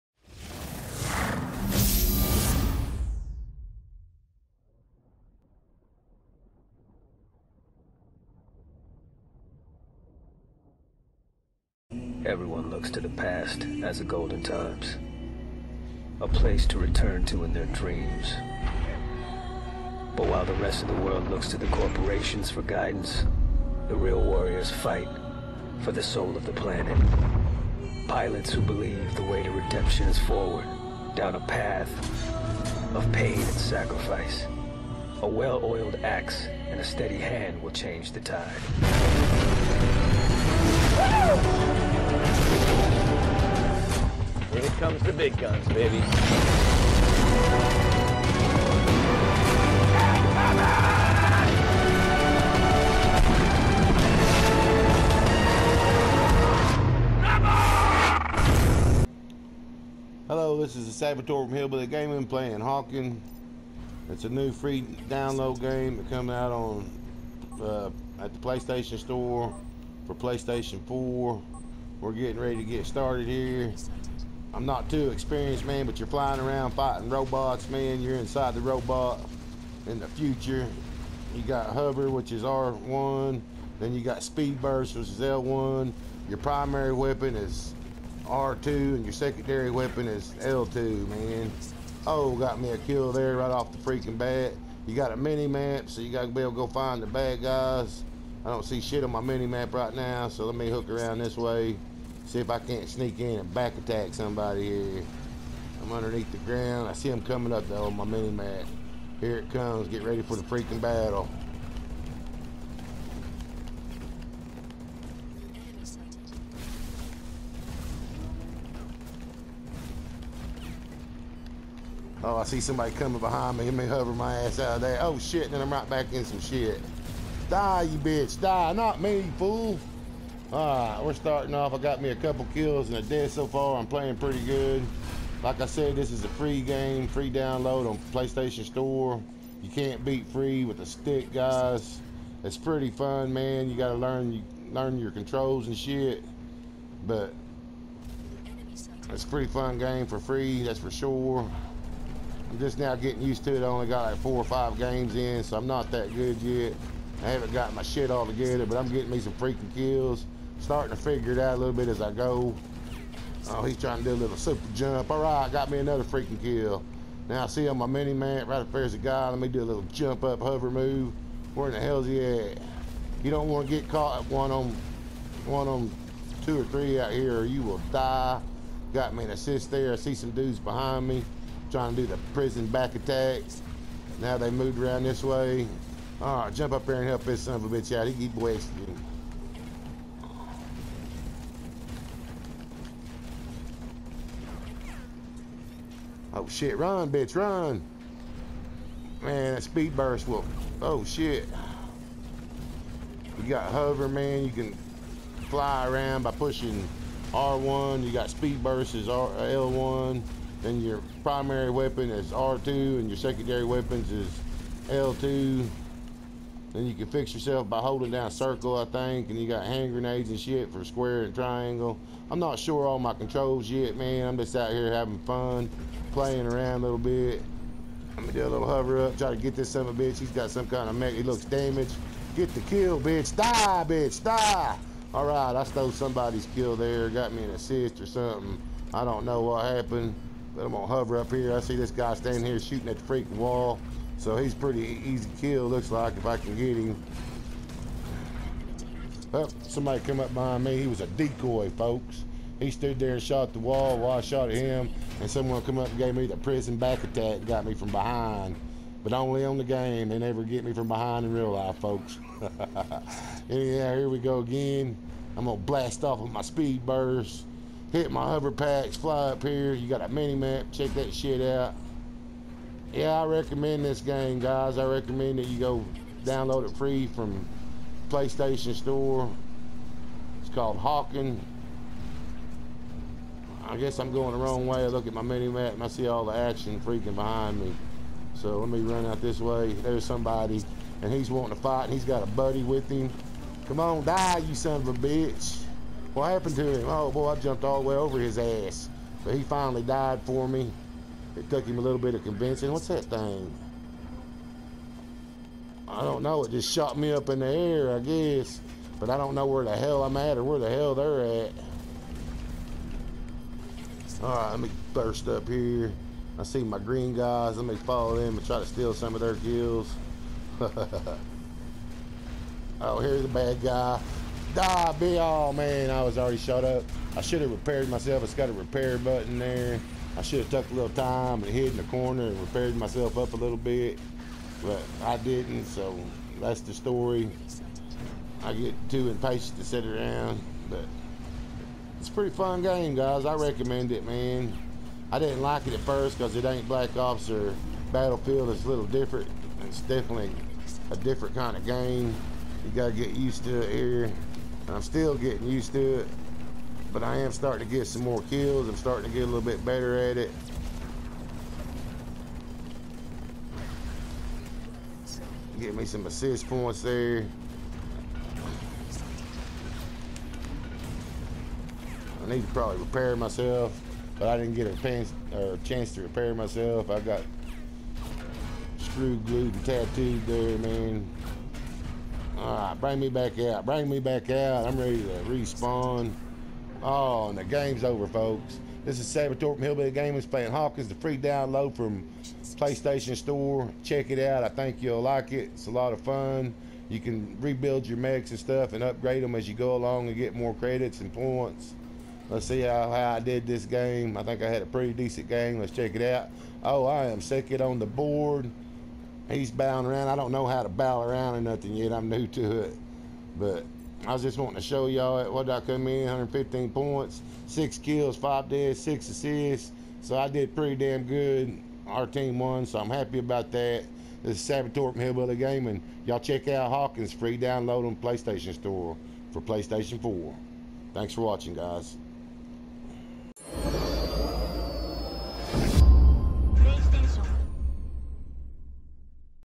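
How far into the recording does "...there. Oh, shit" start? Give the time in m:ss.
2:04.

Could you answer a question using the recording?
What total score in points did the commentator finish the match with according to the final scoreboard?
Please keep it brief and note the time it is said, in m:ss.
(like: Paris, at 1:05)
115, at 6:56.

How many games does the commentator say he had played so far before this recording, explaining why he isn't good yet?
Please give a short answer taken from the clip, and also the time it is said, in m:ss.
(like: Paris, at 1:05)
four or five, at 2:34.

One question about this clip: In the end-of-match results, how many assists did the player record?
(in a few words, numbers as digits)
6.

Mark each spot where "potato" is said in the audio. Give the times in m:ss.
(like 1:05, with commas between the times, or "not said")
not said.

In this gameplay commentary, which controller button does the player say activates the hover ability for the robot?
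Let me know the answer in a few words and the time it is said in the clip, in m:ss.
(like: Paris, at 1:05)
R1, at 1:21.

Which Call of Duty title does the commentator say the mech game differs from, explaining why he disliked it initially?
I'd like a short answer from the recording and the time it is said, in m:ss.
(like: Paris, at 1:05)
Black Ops, at 5:46.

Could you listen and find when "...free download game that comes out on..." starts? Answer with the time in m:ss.
1:04.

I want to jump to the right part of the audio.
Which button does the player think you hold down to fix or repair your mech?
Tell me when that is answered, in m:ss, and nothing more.
3:37.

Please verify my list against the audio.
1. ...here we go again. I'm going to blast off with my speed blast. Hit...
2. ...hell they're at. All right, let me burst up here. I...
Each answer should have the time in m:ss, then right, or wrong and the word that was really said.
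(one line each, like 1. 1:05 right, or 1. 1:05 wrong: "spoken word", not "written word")
1. 4:23 wrong: "burst", not "blast"
2. 5:10 right.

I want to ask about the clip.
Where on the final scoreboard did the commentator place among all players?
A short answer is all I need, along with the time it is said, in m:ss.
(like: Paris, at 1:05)
second, at 6:46.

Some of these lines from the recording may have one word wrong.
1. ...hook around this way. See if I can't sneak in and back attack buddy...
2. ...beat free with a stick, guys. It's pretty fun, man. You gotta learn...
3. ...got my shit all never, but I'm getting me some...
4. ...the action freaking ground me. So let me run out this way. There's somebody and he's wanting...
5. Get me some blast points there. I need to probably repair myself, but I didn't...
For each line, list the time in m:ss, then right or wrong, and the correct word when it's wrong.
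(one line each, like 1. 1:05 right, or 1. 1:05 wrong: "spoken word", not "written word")
1. 1:40 wrong: "somebody", not "buddy"
2. 2:20 right
3. 2:37 wrong: "together", not "never"
4. 4:46 wrong: "behind", not "ground"
5. 6:05 wrong: "assist", not "blast".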